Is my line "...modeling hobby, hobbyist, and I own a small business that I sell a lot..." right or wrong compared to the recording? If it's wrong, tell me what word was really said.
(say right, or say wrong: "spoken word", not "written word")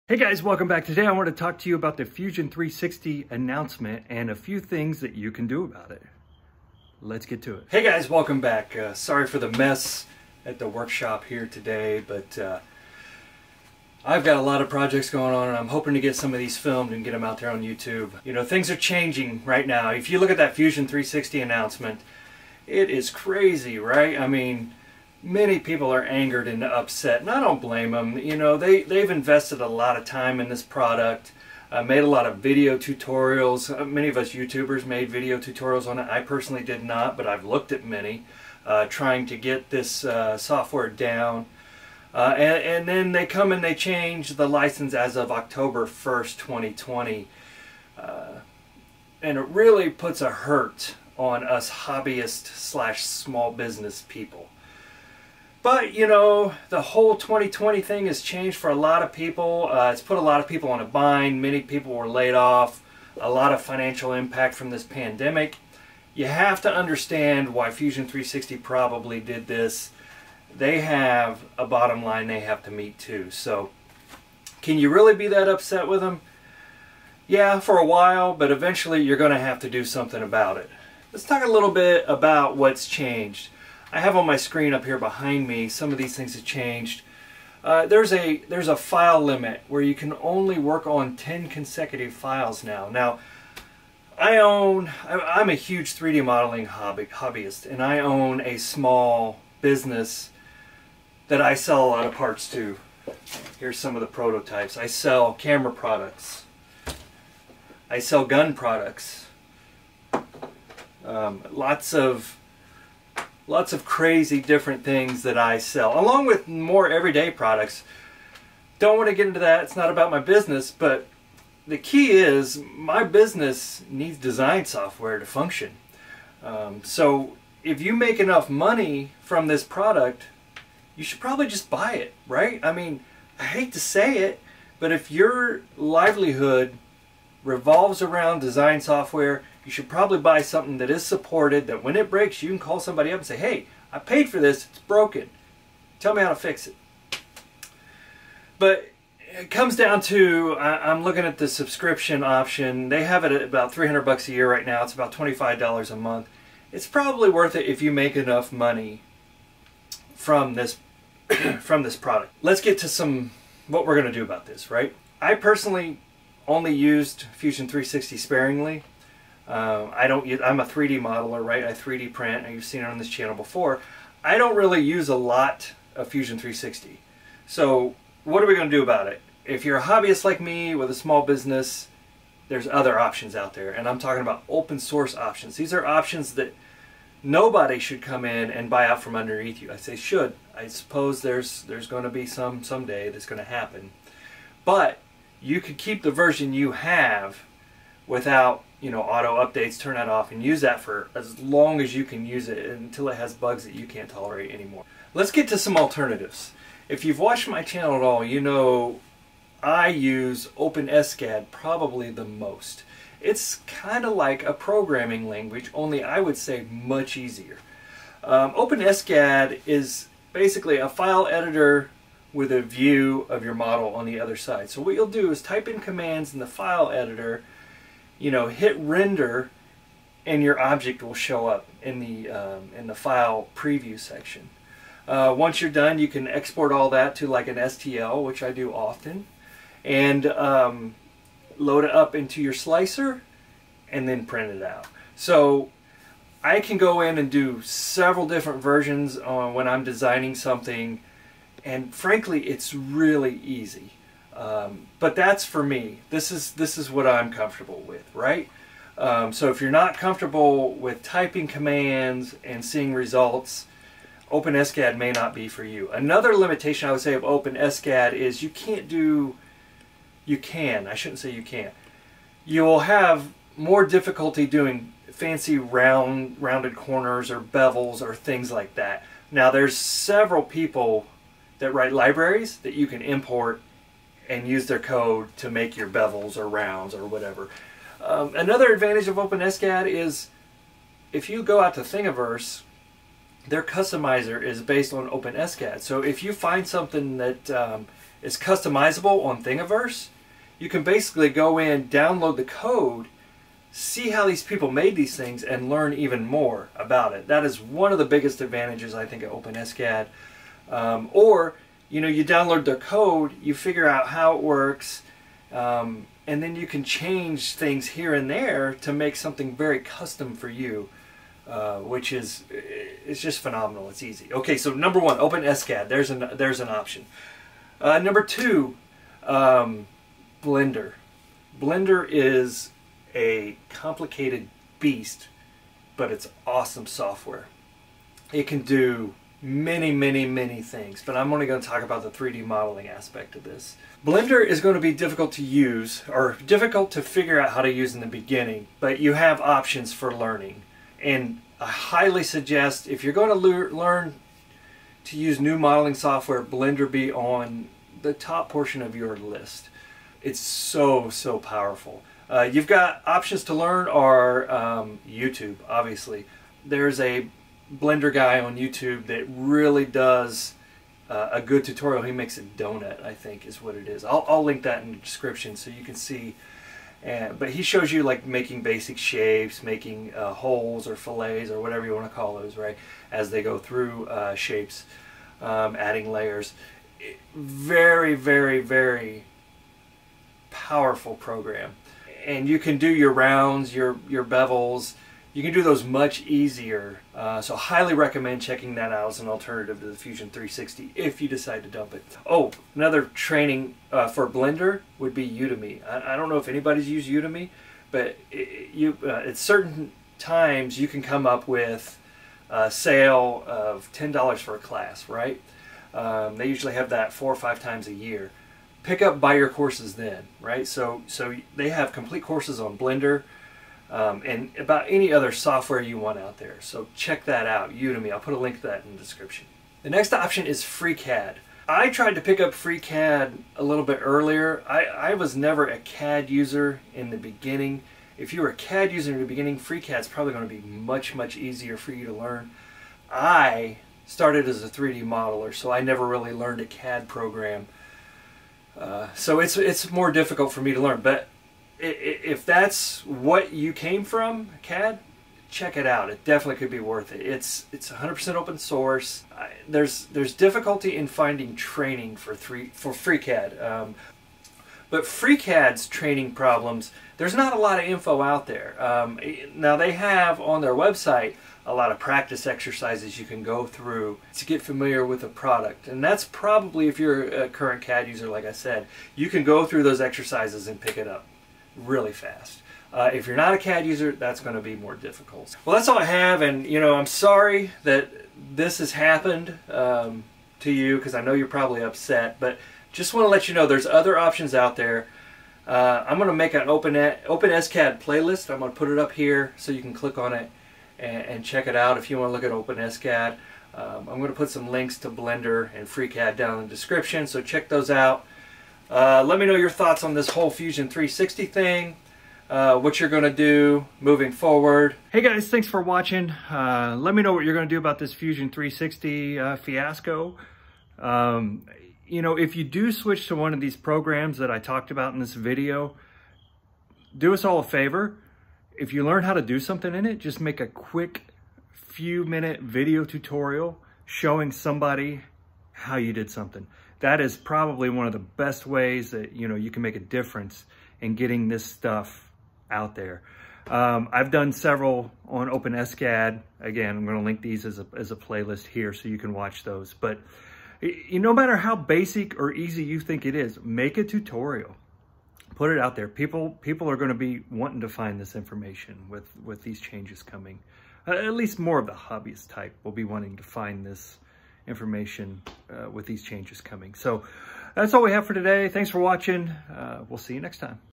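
right.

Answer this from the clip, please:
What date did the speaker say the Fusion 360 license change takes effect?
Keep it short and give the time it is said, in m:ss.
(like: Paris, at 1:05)
October 1st, 2020, at 0:45.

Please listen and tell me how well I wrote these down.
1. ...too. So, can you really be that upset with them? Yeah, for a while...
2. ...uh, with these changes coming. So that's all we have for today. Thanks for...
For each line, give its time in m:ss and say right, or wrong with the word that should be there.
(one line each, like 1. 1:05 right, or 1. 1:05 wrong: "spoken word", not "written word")
1. 1:12 right
2. 9:25 right.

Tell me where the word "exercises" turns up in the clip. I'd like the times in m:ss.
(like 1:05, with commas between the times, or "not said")
7:52, 8:00.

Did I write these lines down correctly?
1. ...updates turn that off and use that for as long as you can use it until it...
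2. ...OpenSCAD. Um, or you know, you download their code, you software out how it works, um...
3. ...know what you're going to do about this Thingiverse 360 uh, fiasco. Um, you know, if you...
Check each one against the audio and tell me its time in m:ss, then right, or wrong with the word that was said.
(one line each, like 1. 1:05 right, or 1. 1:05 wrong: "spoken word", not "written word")
1. 3:19 right
2. 5:09 wrong: "figure", not "software"
3. 8:37 wrong: "Fusion", not "Thingiverse".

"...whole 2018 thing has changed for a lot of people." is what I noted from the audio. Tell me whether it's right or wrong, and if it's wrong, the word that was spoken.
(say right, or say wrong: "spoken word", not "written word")
wrong: "2020", not "2018".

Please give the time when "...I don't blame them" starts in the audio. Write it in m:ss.
0:27.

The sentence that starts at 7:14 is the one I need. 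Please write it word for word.
I, I was never a CAD user in the beginning.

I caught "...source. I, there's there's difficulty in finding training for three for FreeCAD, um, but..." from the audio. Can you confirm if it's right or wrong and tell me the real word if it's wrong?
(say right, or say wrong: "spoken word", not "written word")
right.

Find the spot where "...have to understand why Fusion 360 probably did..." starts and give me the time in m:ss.
1:06.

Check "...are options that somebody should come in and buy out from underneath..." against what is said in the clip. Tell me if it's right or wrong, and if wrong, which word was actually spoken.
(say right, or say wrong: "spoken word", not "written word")
wrong: "nobody", not "somebody".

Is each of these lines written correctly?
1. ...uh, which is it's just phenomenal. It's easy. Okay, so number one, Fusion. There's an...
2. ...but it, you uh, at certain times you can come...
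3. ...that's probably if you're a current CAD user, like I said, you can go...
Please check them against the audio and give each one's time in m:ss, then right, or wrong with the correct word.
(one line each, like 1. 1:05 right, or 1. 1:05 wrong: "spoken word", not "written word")
1. 5:21 wrong: "OpenSCAD", not "Fusion"
2. 6:47 right
3. 7:56 right.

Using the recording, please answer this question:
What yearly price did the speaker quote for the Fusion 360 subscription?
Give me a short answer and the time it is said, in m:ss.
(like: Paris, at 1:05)
300 bucks, at 2:33.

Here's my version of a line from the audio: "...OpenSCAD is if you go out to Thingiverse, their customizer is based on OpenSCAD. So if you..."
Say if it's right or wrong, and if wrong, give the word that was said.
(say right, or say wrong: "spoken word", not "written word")
right.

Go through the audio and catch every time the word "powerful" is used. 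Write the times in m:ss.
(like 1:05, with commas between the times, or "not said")
6:01, 6:30.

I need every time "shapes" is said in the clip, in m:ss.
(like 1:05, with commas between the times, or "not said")
6:18, 6:24.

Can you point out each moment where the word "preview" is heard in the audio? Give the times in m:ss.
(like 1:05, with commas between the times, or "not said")
3:53.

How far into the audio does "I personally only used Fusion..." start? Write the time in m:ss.
2:45.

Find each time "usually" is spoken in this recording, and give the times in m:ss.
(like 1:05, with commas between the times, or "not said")
6:56.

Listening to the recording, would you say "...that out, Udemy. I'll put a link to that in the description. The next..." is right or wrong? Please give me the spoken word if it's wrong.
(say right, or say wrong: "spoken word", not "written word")
right.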